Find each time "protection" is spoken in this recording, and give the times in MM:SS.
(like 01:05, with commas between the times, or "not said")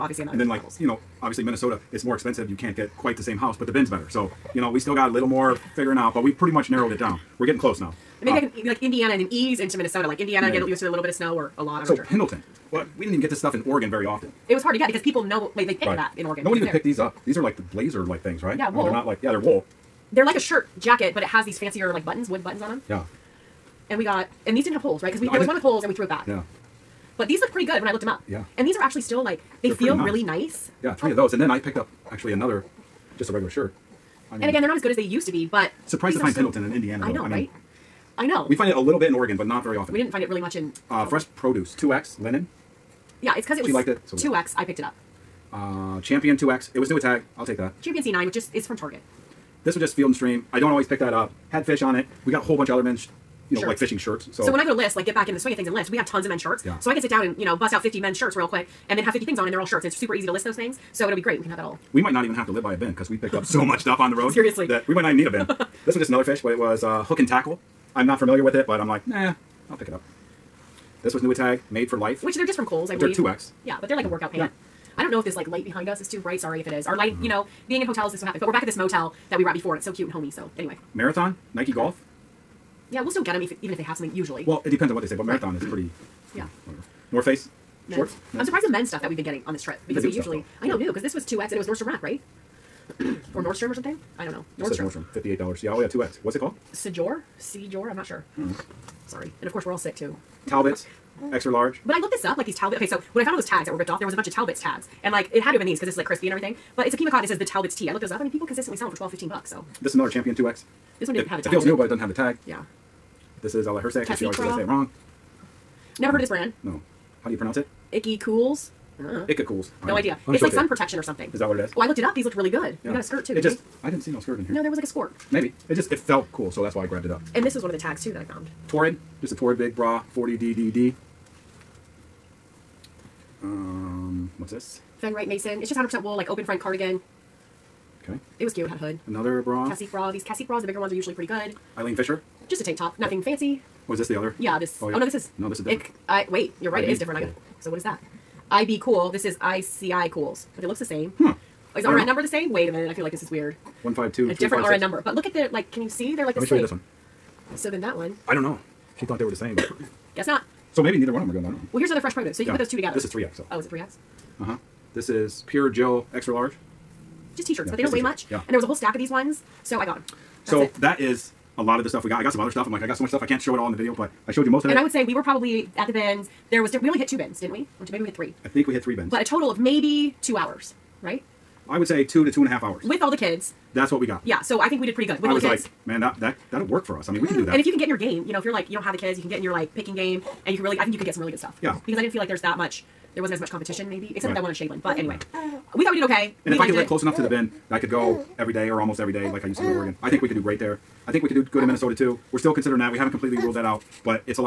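02:00.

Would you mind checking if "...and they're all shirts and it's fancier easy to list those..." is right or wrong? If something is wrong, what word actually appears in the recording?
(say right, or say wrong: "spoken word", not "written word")
wrong: "super", not "fancier".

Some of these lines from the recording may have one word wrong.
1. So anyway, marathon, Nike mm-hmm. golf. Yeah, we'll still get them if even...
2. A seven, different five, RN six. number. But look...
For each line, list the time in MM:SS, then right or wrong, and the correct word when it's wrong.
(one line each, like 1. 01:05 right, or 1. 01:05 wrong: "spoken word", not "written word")
1. 01:20 right
2. 02:34 wrong: "three", not "seven".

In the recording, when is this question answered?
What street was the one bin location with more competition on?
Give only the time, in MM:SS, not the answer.
03:14.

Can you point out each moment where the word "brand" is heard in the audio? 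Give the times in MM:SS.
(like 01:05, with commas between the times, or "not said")
01:56.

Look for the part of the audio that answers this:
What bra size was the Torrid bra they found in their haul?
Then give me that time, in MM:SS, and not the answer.
02:10.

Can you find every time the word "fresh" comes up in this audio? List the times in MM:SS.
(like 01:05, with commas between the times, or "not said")
00:41, 02:41.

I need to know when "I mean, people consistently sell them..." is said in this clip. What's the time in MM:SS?
01:48.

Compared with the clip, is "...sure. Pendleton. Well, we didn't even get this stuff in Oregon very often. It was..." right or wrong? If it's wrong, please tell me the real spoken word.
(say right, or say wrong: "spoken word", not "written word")
right.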